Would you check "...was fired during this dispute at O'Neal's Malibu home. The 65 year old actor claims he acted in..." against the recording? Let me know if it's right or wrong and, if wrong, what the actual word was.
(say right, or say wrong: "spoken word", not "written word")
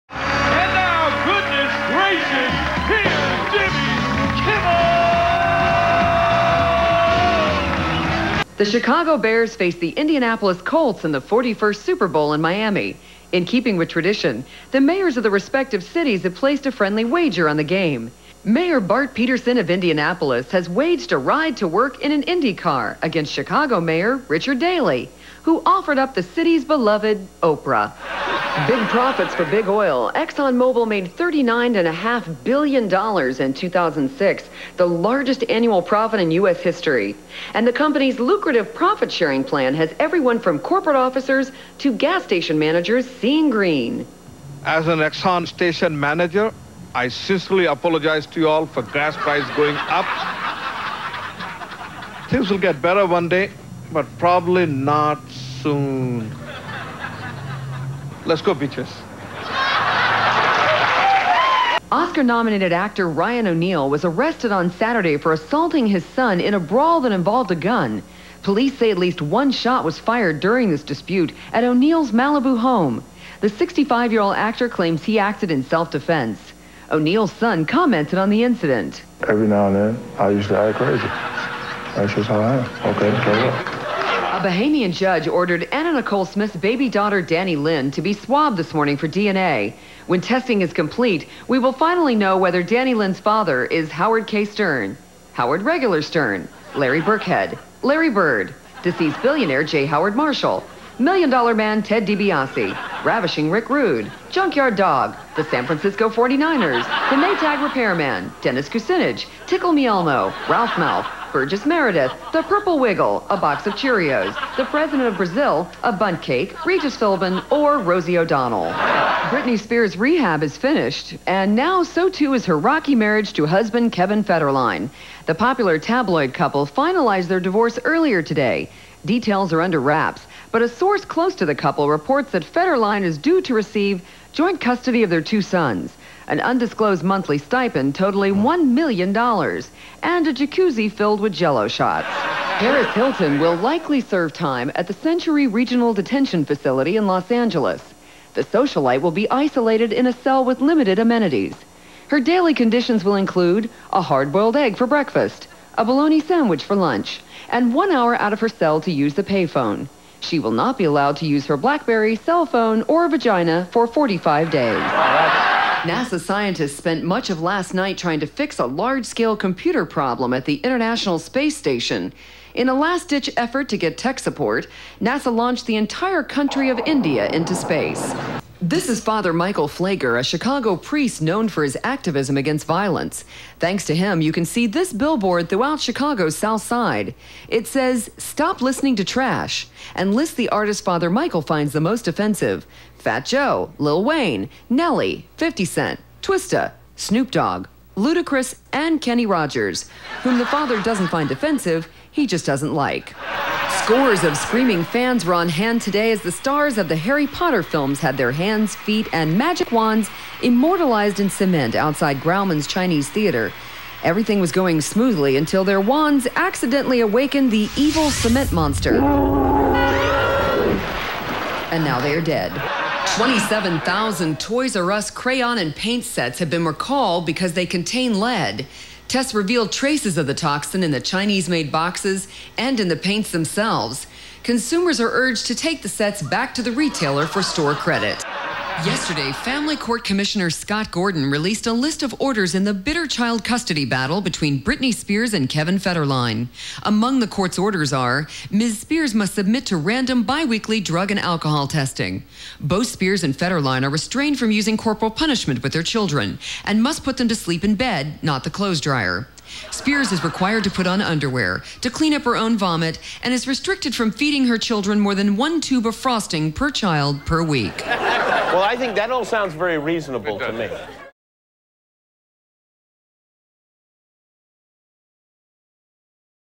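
right.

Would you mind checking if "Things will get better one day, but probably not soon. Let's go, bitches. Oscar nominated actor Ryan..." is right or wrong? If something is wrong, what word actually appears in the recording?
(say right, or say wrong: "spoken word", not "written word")
right.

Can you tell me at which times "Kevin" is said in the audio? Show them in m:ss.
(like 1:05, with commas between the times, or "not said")
2:03, 4:05.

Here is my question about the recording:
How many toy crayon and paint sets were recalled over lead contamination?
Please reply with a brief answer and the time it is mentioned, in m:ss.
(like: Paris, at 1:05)
27,000, at 3:43.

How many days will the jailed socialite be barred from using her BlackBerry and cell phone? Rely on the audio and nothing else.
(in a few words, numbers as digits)
45.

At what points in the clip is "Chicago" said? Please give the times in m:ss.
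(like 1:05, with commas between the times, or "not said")
0:08, 0:23, 3:00, 3:05.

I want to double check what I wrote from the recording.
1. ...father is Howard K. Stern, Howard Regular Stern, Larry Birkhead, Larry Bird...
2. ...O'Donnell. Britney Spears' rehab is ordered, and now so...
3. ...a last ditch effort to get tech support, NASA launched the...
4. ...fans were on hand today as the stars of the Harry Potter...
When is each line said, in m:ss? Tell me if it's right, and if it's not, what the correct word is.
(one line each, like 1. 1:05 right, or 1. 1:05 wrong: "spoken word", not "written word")
1. 1:33 right
2. 1:58 wrong: "finished", not "ordered"
3. 2:52 right
4. 3:24 right.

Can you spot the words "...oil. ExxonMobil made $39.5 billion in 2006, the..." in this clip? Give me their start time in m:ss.
0:29.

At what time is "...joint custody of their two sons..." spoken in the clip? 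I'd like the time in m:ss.
2:14.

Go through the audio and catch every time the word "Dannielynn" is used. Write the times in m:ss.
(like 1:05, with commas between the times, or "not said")
1:27, 1:32.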